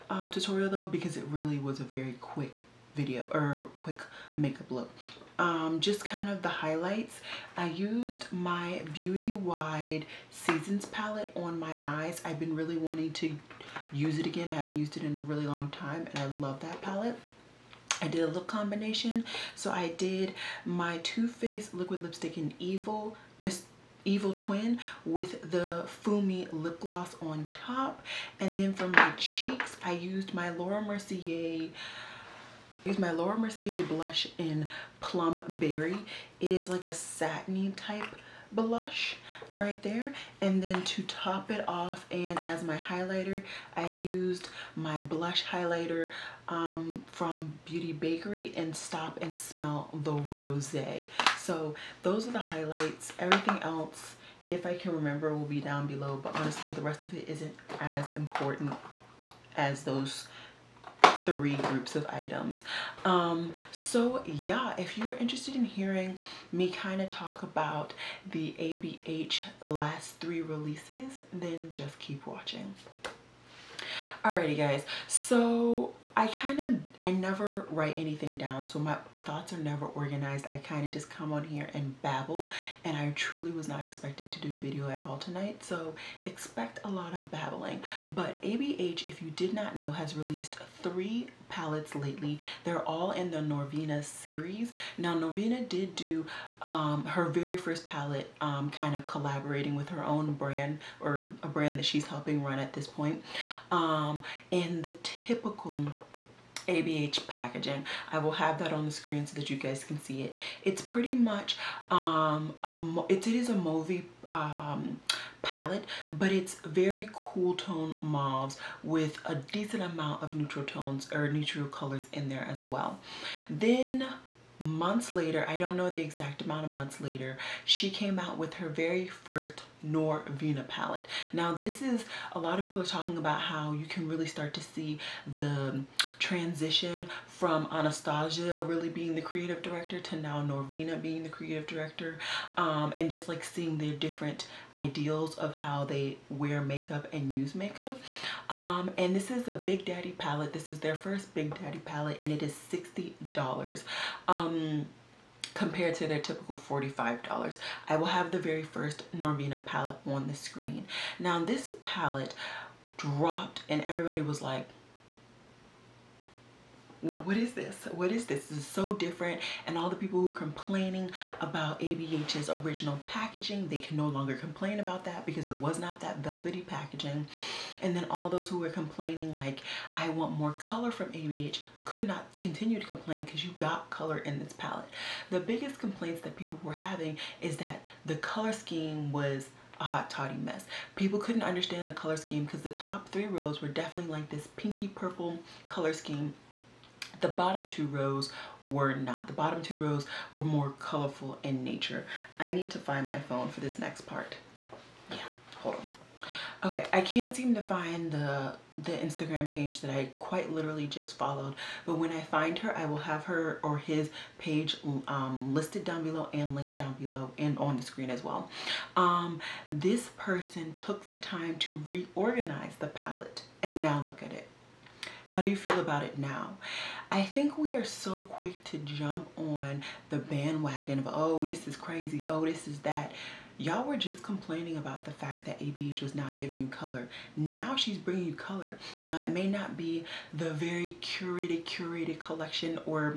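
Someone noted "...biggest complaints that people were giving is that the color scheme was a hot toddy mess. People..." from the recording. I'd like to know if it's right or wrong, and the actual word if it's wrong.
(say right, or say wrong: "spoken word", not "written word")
wrong: "having", not "giving".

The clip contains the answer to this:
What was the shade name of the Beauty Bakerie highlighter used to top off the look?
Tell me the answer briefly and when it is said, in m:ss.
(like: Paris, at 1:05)
Stop and Smell the Rose, at 0:48.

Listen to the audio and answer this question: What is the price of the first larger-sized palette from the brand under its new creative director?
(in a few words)
$60.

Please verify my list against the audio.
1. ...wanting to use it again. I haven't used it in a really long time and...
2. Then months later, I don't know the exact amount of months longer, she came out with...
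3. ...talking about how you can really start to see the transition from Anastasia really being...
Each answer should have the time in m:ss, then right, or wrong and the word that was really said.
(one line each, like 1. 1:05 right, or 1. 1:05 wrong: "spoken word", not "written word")
1. 0:12 right
2. 2:03 wrong: "later", not "longer"
3. 2:12 right.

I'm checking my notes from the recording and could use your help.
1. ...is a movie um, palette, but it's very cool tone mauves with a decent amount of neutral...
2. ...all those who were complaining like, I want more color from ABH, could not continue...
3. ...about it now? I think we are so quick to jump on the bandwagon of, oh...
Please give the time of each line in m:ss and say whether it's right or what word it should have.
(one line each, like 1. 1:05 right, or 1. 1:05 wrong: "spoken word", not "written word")
1. 1:53 right
2. 2:58 right
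3. 3:45 right.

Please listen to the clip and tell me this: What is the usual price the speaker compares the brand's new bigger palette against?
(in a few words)
$45.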